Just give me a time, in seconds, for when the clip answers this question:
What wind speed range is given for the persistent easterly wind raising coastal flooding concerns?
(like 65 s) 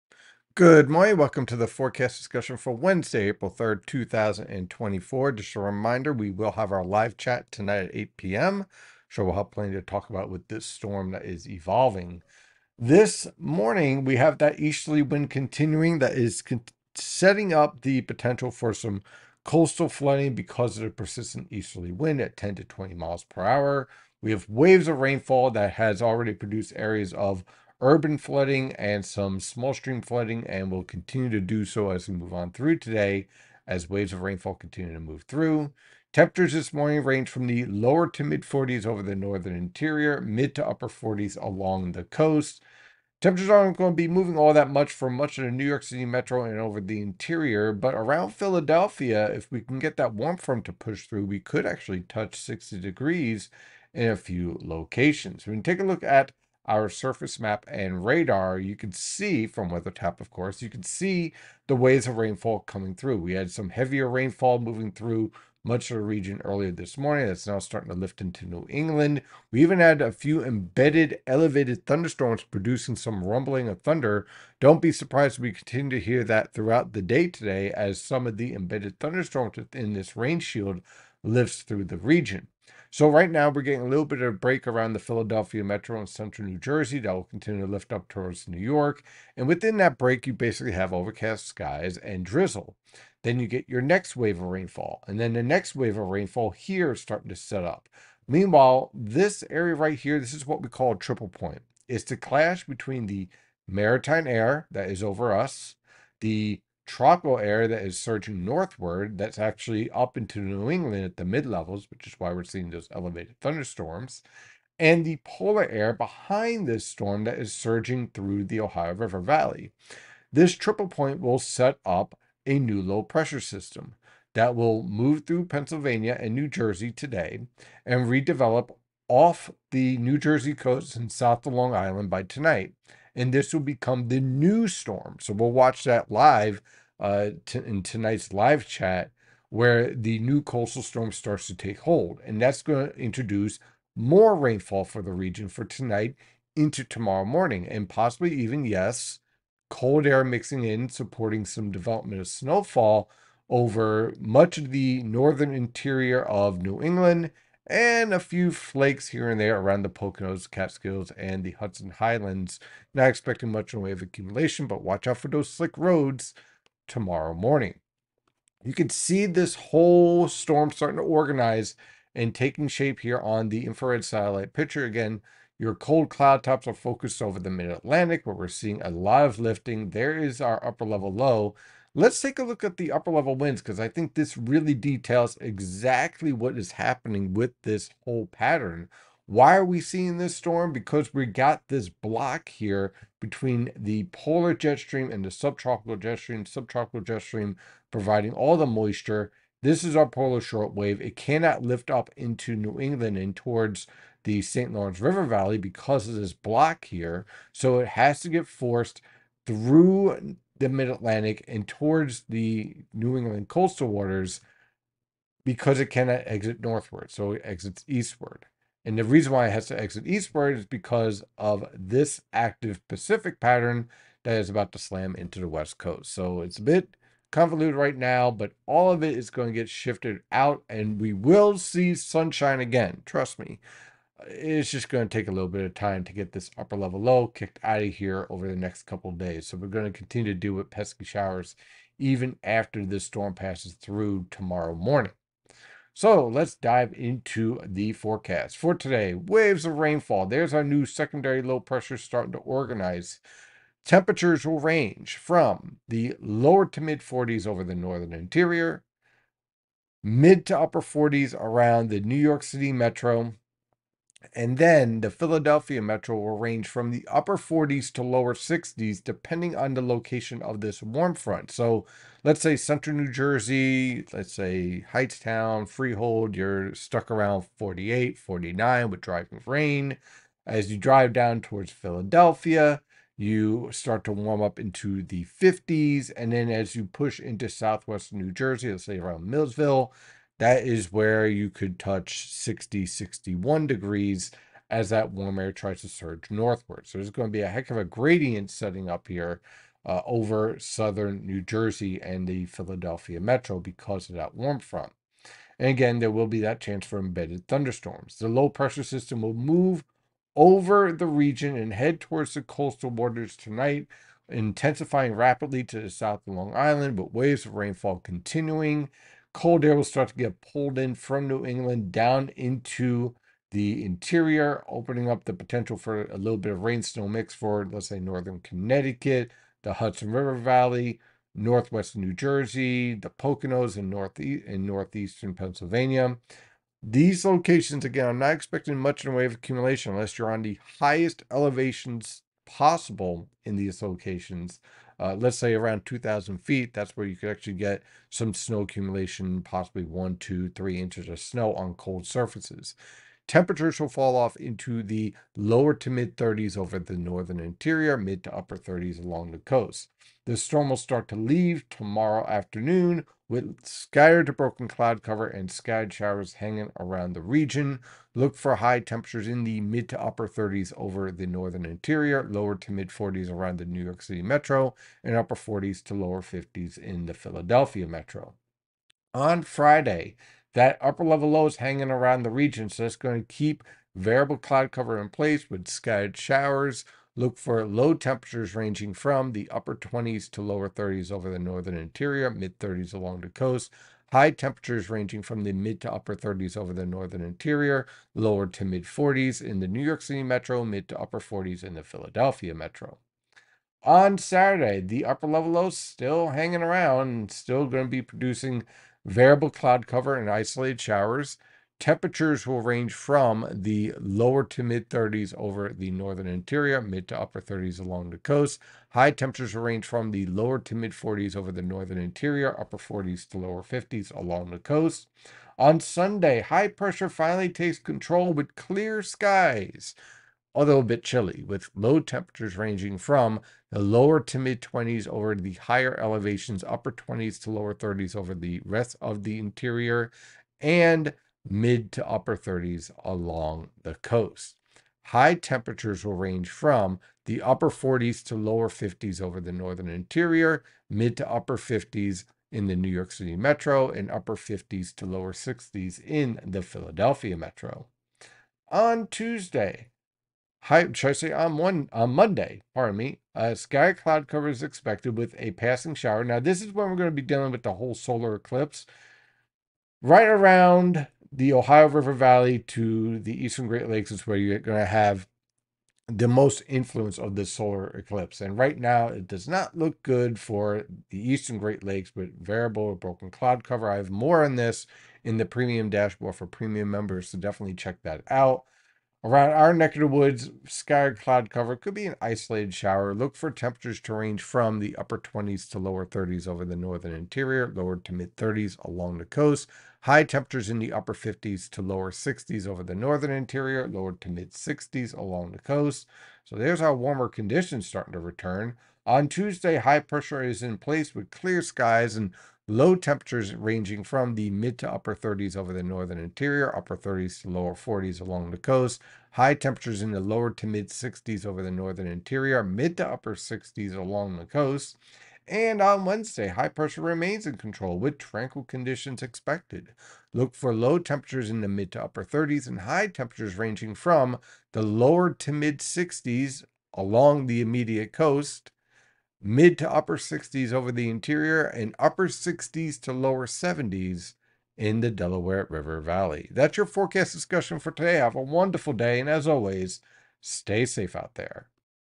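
22 s.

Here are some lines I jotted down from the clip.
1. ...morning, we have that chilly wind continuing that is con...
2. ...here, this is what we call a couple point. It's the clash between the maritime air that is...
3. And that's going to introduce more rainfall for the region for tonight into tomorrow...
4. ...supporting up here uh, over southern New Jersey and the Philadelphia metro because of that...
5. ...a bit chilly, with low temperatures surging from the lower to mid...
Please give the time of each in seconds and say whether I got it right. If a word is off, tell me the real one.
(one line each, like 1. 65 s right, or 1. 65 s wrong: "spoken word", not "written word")
1. 13 s wrong: "easterly", not "chilly"
2. 99 s wrong: "triple", not "couple"
3. 142 s right
4. 298 s wrong: "setting", not "supporting"
5. 430 s wrong: "ranging", not "surging".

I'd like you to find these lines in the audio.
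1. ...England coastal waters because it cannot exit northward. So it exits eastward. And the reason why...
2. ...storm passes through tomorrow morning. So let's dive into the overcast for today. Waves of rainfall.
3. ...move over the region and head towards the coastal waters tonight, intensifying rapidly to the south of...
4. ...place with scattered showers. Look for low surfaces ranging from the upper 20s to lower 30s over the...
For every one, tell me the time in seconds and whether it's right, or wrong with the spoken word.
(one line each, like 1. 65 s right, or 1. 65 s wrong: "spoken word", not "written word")
1. 213 s right
2. 243 s wrong: "forecast", not "overcast"
3. 309 s right
4. 385 s wrong: "temperatures", not "surfaces".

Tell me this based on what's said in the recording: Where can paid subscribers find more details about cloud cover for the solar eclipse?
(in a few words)
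premium dashboard.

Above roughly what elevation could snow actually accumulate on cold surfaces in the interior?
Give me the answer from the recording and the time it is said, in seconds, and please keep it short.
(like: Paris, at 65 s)
2,000 feet, at 345 s.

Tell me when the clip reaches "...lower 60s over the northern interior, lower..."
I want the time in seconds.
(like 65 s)
501 s.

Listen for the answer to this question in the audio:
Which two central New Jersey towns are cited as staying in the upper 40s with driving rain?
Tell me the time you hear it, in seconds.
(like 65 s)
274 s.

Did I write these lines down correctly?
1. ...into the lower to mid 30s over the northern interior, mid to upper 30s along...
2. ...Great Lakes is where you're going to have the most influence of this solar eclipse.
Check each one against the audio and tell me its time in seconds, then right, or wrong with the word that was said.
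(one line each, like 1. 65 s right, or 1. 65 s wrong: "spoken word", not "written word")
1. 354 s right
2. 473 s right.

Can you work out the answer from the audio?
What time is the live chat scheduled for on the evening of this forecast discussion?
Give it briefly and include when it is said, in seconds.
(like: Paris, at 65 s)
8 p.m., at 7 s.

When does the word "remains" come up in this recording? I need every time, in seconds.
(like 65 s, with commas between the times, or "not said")
527 s.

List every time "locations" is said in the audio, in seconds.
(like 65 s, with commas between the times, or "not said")
54 s, 269 s, 337 s, 343 s.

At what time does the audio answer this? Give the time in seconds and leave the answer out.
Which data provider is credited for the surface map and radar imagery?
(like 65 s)
59 s.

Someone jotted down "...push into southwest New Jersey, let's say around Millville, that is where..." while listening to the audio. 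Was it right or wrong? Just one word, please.
right.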